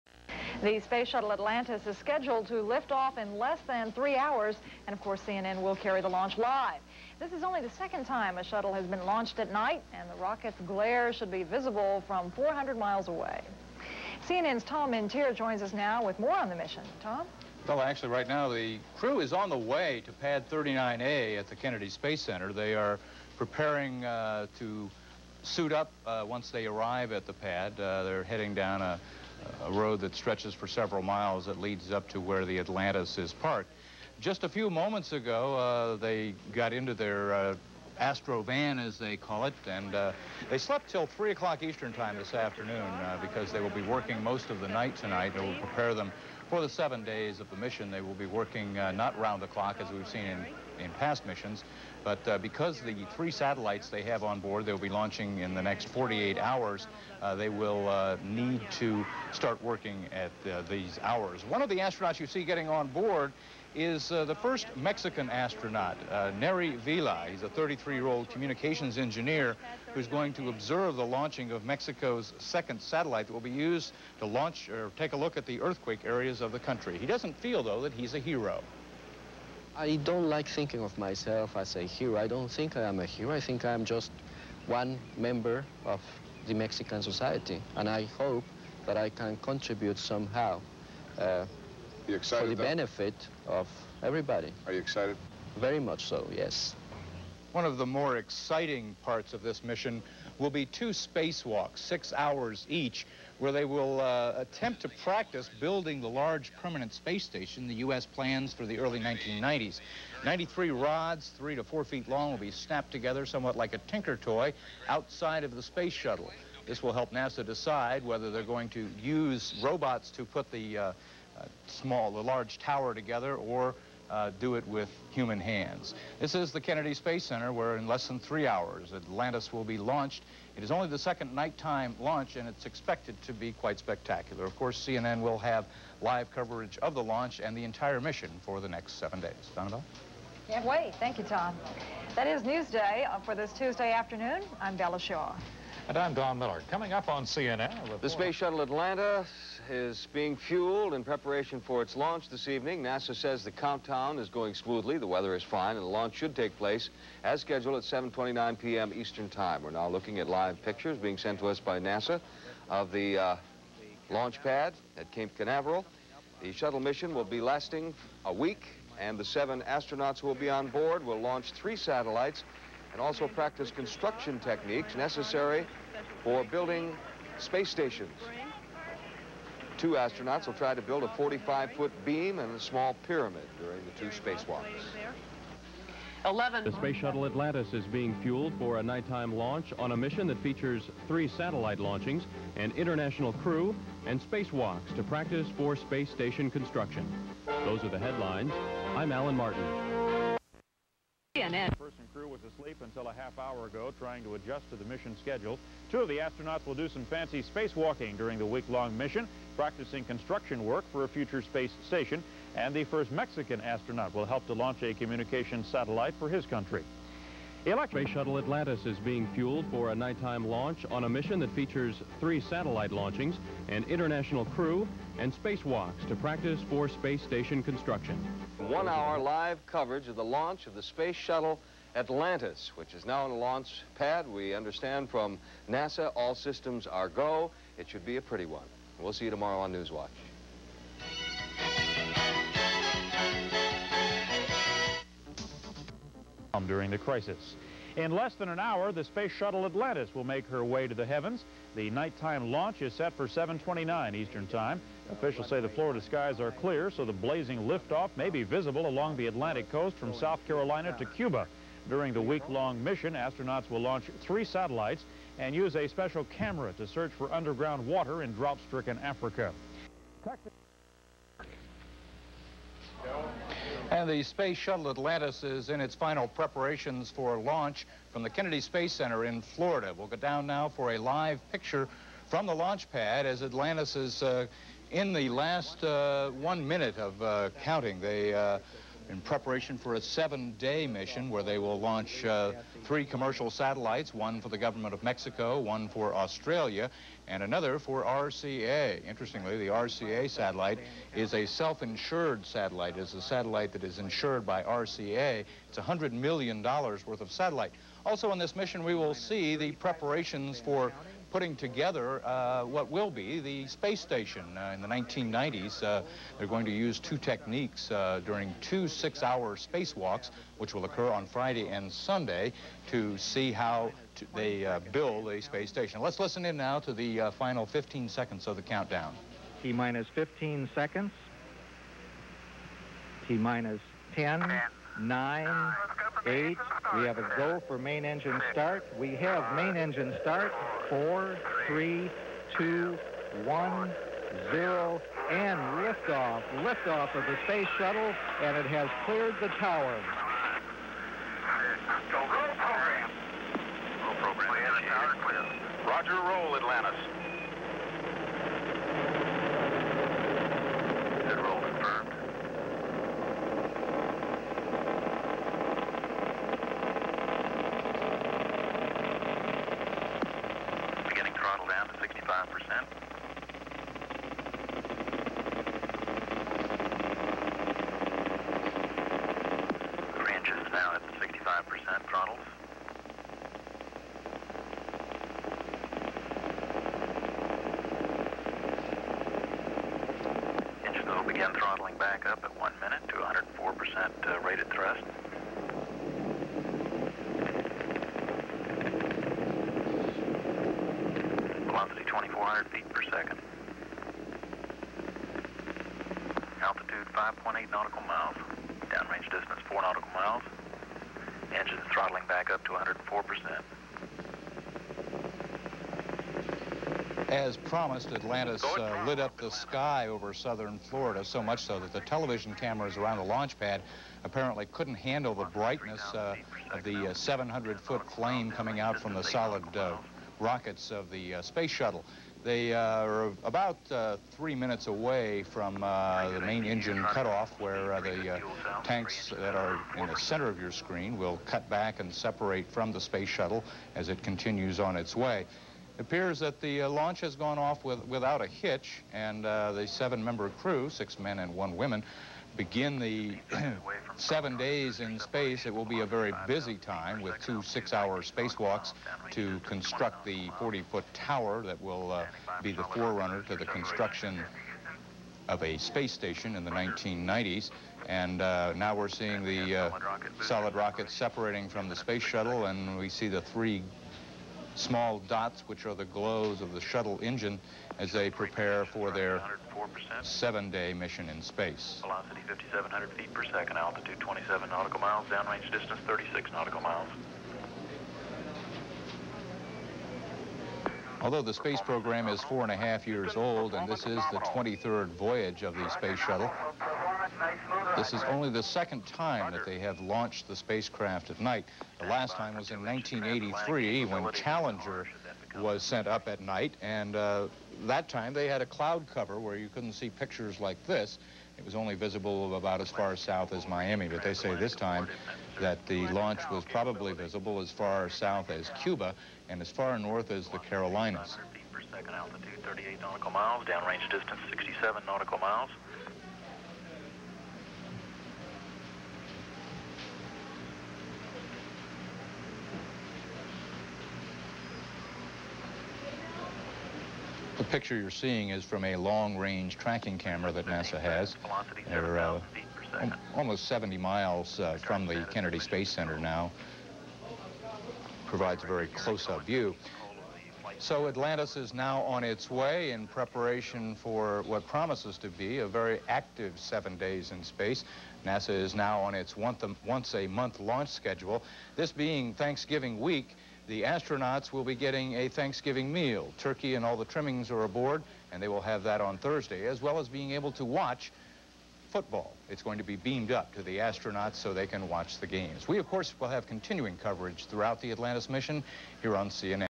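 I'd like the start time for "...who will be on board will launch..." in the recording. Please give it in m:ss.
2:50.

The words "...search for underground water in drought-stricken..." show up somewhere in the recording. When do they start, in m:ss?
4:26.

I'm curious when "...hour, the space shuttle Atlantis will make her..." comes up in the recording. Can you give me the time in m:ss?
4:08.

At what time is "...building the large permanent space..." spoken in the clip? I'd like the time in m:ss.
1:45.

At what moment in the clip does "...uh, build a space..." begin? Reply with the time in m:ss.
5:24.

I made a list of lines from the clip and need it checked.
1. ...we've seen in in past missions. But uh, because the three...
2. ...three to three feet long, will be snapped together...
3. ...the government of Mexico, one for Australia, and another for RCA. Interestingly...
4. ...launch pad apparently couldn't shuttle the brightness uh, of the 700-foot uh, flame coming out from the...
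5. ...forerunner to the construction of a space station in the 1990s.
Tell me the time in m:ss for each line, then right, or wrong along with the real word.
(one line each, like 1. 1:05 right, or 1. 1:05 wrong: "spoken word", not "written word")
1. 0:49 right
2. 1:51 wrong: "four", not "three"
3. 4:54 right
4. 7:03 wrong: "handle", not "shuttle"
5. 7:42 right.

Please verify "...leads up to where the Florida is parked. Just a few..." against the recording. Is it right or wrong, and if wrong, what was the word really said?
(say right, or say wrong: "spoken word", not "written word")
wrong: "Atlantis", not "Florida".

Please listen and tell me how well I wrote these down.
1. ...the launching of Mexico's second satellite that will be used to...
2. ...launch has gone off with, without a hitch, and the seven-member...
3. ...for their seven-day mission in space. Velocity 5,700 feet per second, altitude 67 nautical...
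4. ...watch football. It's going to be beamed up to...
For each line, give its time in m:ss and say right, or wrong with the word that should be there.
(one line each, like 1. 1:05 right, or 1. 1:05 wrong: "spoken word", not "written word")
1. 1:10 right
2. 7:26 right
3. 7:58 wrong: "27", not "67"
4. 9:30 right.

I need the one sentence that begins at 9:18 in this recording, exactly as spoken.
NASA is now on its once a month launch schedule, this being Thanksgiving week.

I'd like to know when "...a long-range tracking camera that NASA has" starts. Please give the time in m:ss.
8:58.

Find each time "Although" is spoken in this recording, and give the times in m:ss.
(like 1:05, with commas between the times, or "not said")
8:11.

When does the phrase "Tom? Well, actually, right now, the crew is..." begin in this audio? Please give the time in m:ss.
0:17.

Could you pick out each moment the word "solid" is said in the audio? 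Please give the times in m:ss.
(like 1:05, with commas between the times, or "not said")
7:09, 7:50.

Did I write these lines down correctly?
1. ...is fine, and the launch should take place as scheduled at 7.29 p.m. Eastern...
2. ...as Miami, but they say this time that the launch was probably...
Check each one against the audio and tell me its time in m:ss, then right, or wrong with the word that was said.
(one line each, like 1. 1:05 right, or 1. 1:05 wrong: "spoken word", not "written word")
1. 2:35 right
2. 8:33 right.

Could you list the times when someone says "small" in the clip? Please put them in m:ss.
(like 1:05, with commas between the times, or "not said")
2:01, 3:02, 7:54.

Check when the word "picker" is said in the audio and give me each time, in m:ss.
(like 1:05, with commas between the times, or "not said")
not said.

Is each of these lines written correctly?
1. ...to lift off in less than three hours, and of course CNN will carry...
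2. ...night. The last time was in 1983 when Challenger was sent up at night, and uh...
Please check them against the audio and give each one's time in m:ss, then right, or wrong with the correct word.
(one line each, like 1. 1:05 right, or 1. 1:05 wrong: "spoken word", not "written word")
1. 0:02 right
2. 8:21 right.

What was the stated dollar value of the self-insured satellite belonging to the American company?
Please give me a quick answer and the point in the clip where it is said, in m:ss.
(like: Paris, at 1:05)
$100 million, at 5:05.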